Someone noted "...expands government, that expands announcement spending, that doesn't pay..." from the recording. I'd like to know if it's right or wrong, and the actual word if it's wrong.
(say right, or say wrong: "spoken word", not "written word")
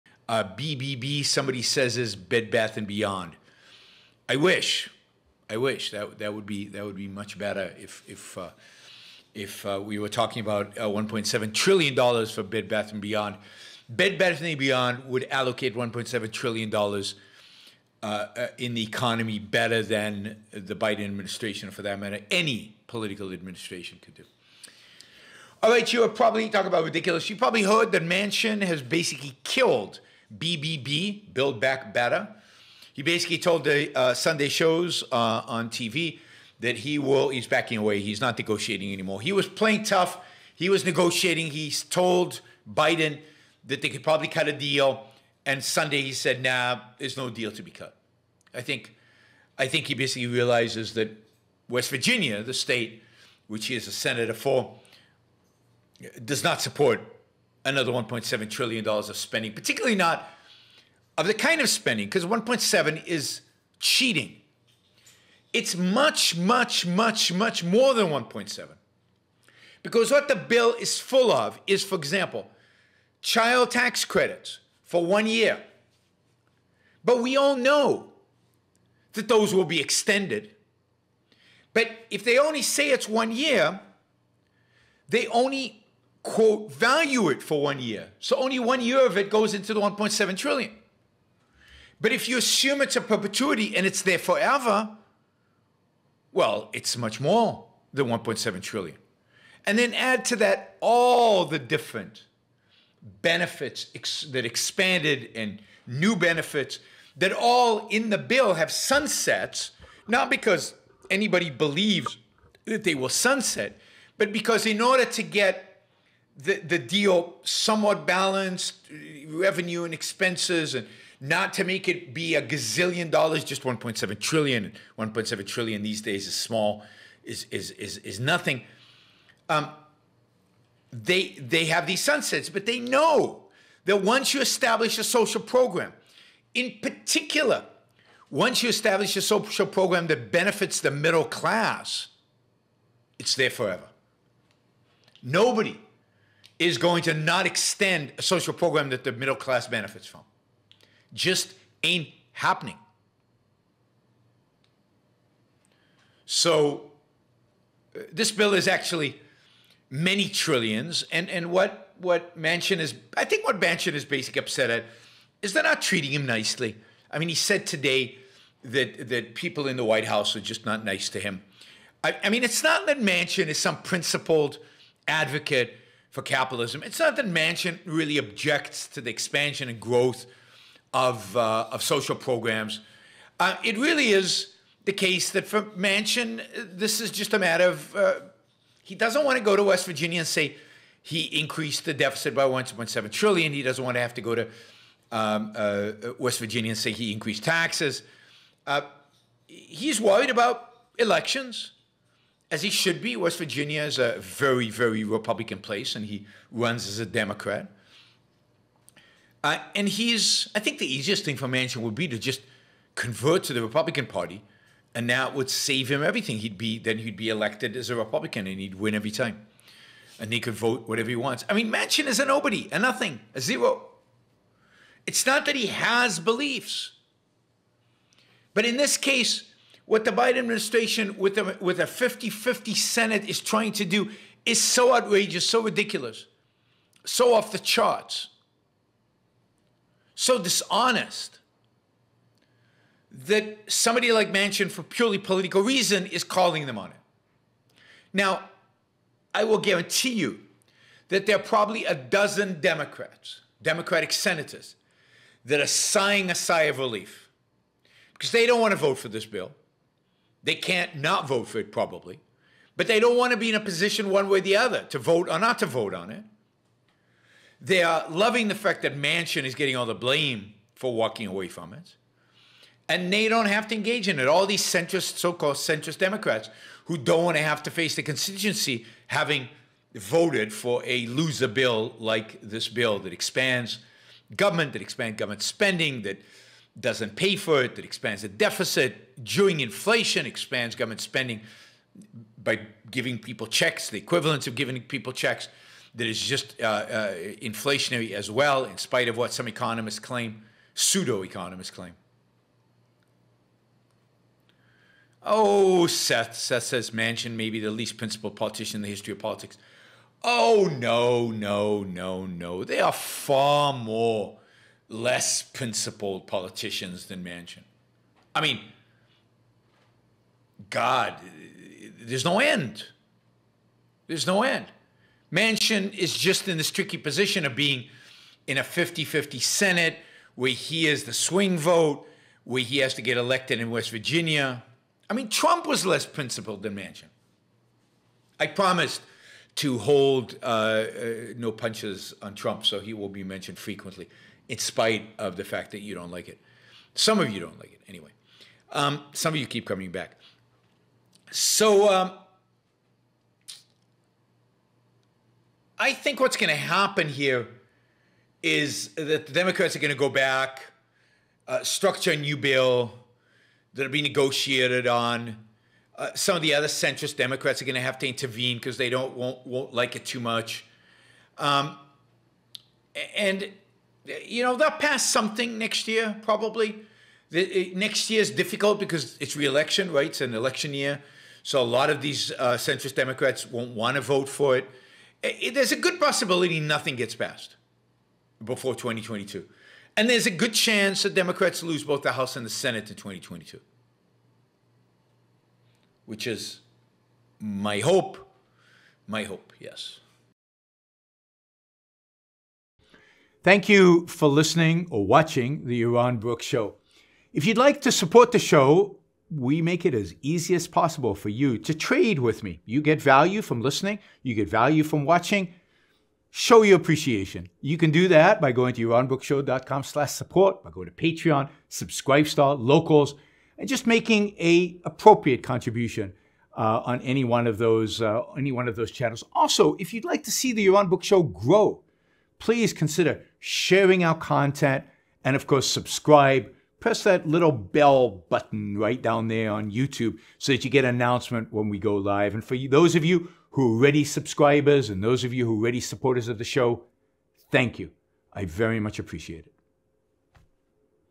wrong: "government", not "announcement".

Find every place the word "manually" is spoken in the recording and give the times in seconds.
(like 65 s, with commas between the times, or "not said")
not said.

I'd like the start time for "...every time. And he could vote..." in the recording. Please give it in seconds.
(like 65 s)
218 s.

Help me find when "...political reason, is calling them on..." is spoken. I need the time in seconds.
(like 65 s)
245 s.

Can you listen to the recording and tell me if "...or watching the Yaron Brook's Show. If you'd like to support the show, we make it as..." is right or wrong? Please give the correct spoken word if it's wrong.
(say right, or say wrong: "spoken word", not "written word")
right.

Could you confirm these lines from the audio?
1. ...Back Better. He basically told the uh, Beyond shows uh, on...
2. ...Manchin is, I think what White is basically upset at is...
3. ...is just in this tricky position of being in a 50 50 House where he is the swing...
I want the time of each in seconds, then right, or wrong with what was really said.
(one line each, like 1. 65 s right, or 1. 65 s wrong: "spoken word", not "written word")
1. 31 s wrong: "Sunday", not "Beyond"
2. 162 s wrong: "Manchin", not "White"
3. 325 s wrong: "Senate", not "House".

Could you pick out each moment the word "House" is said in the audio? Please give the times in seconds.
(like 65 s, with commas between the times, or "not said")
170 s, 392 s.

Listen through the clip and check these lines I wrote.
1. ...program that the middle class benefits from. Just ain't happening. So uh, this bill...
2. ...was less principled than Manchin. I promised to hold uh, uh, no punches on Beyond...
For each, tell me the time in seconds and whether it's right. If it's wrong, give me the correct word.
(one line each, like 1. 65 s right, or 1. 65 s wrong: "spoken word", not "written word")
1. 148 s right
2. 335 s wrong: "Trump", not "Beyond".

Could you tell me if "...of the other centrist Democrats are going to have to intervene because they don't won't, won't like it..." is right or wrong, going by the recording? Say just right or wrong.
right.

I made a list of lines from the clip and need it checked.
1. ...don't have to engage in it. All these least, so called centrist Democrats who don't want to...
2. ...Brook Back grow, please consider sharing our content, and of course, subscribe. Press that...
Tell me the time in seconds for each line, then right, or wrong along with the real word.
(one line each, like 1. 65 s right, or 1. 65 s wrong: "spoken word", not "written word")
1. 273 s wrong: "centrist", not "least"
2. 430 s wrong: "Show", not "Back".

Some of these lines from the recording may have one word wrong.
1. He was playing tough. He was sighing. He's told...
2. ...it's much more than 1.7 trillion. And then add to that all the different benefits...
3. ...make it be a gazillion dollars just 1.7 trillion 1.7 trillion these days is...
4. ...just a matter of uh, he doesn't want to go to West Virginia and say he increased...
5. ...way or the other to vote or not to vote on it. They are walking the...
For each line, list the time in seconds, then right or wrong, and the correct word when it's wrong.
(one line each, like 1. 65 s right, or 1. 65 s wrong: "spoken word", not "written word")
1. 39 s wrong: "negotiating", not "sighing"
2. 96 s right
3. 121 s right
4. 187 s right
5. 264 s wrong: "loving", not "walking".